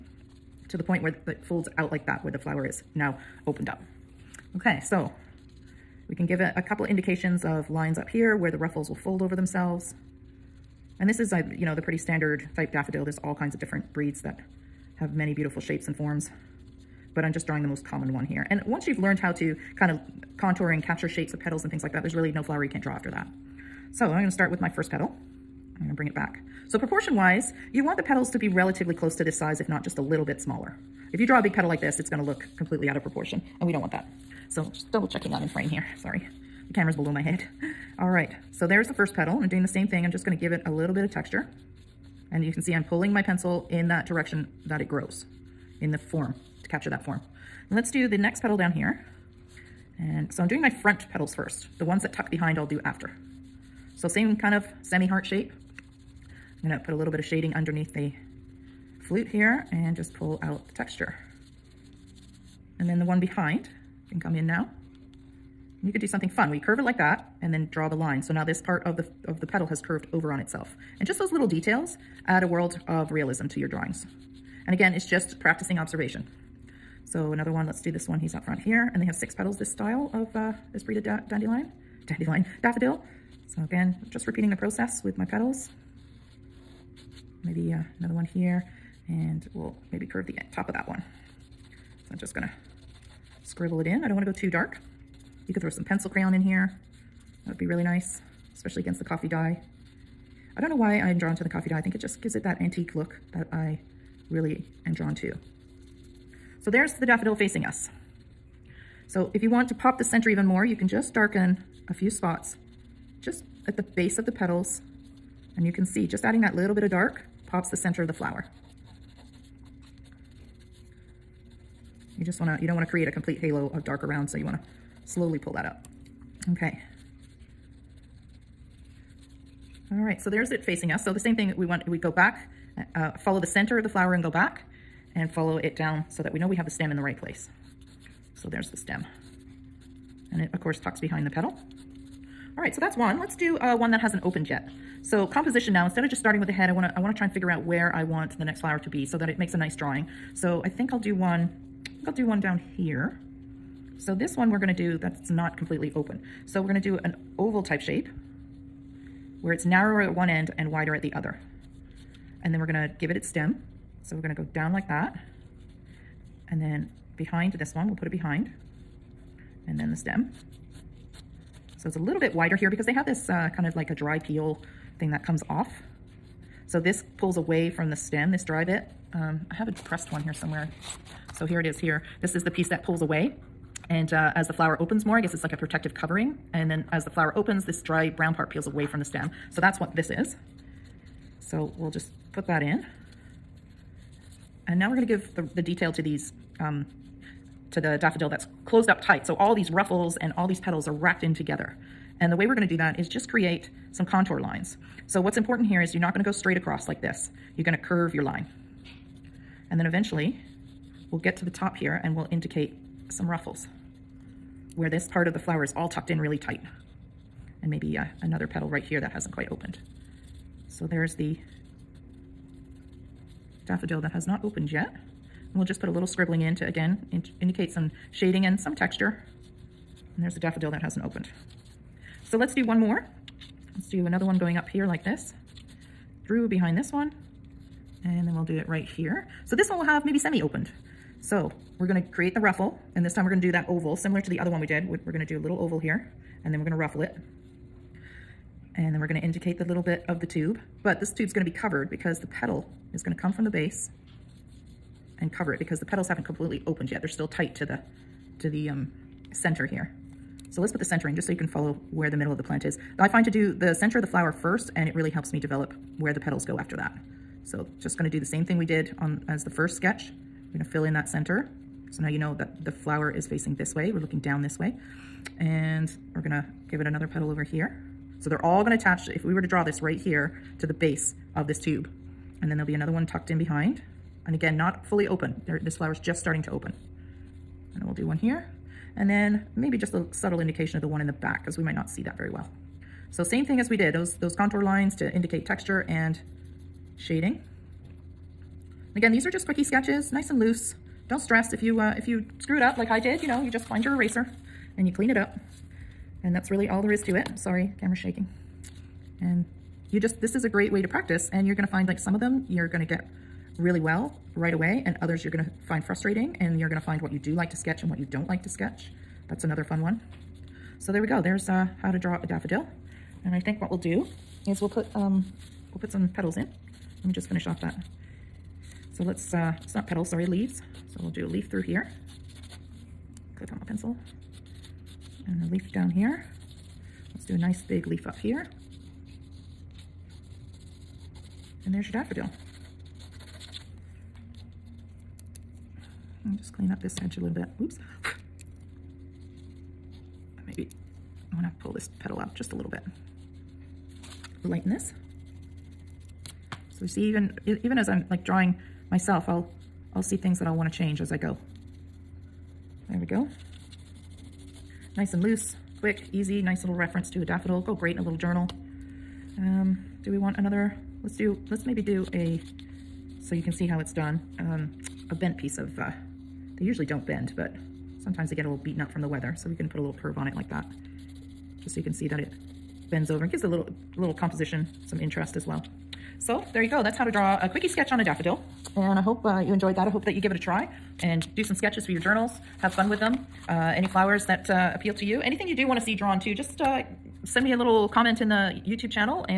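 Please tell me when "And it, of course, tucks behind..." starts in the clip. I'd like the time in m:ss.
2:20.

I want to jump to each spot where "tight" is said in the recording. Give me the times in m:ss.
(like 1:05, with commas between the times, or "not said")
3:19, 3:36, 4:17.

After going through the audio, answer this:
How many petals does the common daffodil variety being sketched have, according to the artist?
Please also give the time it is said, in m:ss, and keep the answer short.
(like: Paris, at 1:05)
6, at 1:19.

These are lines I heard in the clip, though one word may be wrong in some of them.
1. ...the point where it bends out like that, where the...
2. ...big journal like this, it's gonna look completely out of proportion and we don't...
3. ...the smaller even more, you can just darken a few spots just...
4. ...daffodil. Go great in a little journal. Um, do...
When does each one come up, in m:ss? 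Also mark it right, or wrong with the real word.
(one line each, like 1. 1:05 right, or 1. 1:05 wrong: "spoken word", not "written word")
1. 0:00 wrong: "folds", not "bends"
2. 0:31 wrong: "petal", not "journal"
3. 1:49 wrong: "center", not "smaller"
4. 6:07 right.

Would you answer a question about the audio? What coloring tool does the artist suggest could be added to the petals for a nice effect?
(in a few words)
pencil crayon.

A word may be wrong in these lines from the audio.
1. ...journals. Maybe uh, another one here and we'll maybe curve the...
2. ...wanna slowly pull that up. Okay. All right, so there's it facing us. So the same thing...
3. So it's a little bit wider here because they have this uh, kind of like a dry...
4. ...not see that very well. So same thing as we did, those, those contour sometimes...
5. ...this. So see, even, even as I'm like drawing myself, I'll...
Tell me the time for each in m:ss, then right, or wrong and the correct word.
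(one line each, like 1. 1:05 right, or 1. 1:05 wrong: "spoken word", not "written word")
1. 1:25 wrong: "petals", not "journals"
2. 2:04 right
3. 2:51 right
4. 4:51 wrong: "lines", not "sometimes"
5. 5:54 right.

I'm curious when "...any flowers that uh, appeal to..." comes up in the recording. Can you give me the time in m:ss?
6:33.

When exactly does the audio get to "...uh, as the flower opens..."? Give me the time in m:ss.
3:04.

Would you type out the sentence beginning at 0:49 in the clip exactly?
And so I'm doing my front petals first.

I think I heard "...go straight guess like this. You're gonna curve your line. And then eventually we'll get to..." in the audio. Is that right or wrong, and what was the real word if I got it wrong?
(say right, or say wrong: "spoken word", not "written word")
wrong: "across", not "guess".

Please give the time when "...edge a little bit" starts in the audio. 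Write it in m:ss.
5:47.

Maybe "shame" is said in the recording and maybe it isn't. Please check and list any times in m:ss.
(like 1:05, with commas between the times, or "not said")
not said.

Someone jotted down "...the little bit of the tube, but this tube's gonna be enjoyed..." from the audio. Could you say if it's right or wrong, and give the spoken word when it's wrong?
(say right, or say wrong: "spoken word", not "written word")
wrong: "covered", not "enjoyed".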